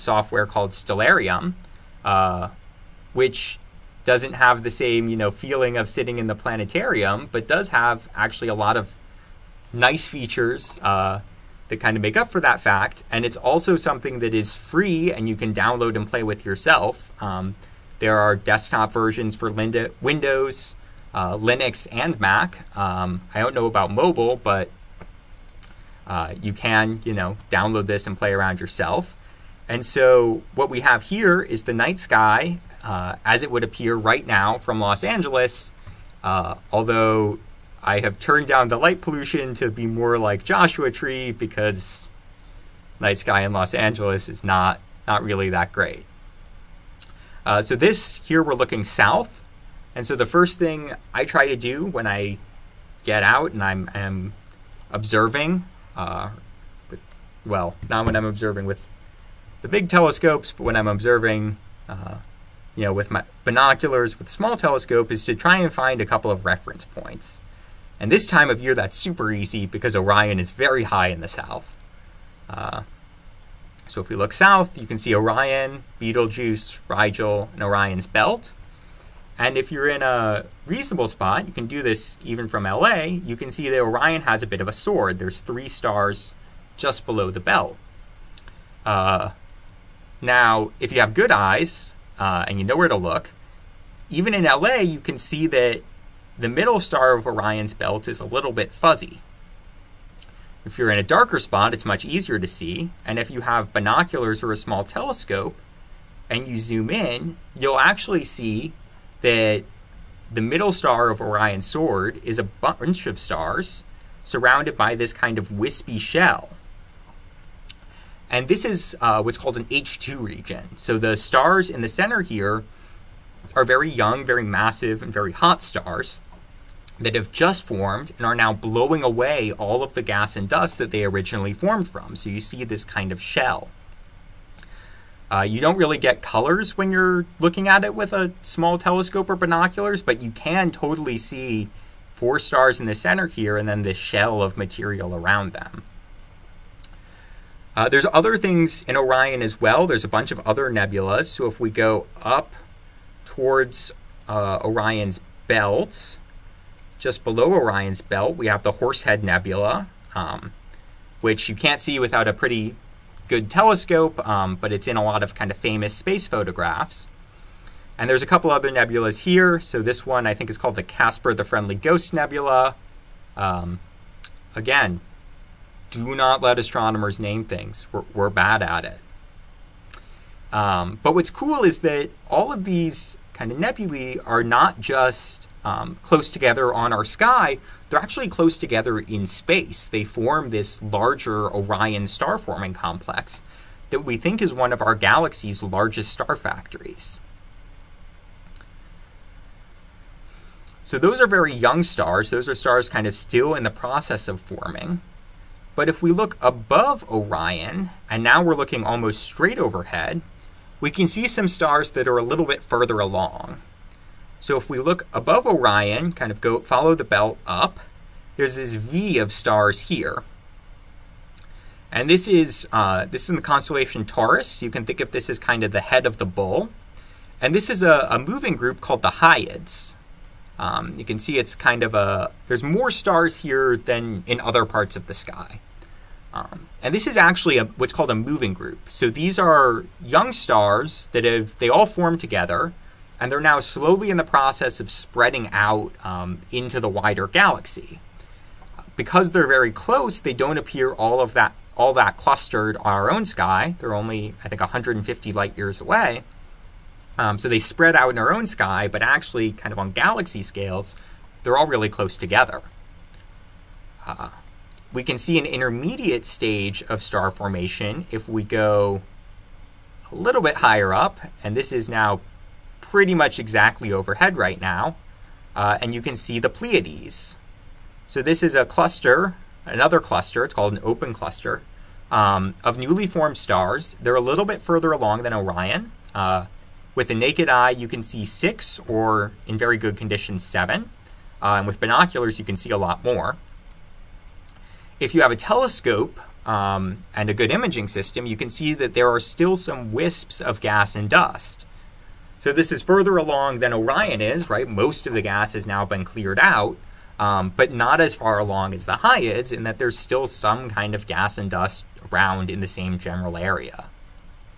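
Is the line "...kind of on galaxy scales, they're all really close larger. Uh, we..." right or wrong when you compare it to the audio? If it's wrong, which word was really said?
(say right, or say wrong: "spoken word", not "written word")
wrong: "together", not "larger".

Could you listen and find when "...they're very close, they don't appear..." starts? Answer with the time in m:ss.
4:09.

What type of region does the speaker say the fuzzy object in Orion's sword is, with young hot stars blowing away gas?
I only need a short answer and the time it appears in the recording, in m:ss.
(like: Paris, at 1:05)
H II region, at 1:59.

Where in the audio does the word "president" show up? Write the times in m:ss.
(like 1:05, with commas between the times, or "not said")
not said.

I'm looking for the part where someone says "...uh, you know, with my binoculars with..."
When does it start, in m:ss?
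1:01.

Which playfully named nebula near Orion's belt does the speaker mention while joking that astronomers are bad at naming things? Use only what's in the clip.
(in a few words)
Casper the Friendly Ghost Nebula.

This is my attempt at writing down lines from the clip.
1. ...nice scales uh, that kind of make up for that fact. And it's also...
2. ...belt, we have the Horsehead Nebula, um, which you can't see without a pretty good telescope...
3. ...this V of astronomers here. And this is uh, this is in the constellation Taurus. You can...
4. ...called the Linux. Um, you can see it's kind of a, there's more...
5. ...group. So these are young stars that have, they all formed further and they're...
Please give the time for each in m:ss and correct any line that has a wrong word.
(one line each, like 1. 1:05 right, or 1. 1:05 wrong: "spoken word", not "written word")
1. 0:09 wrong: "features", not "scales"
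2. 2:38 right
3. 3:38 wrong: "stars", not "astronomers"
4. 3:48 wrong: "Hyades", not "Linux"
5. 3:58 wrong: "together", not "further".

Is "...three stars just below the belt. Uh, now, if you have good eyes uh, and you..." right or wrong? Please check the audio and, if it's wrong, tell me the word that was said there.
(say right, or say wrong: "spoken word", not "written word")
right.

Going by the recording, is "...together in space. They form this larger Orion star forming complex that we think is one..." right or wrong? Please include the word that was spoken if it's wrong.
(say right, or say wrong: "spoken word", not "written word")
right.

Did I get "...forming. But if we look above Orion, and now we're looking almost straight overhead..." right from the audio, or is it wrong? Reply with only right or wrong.
right.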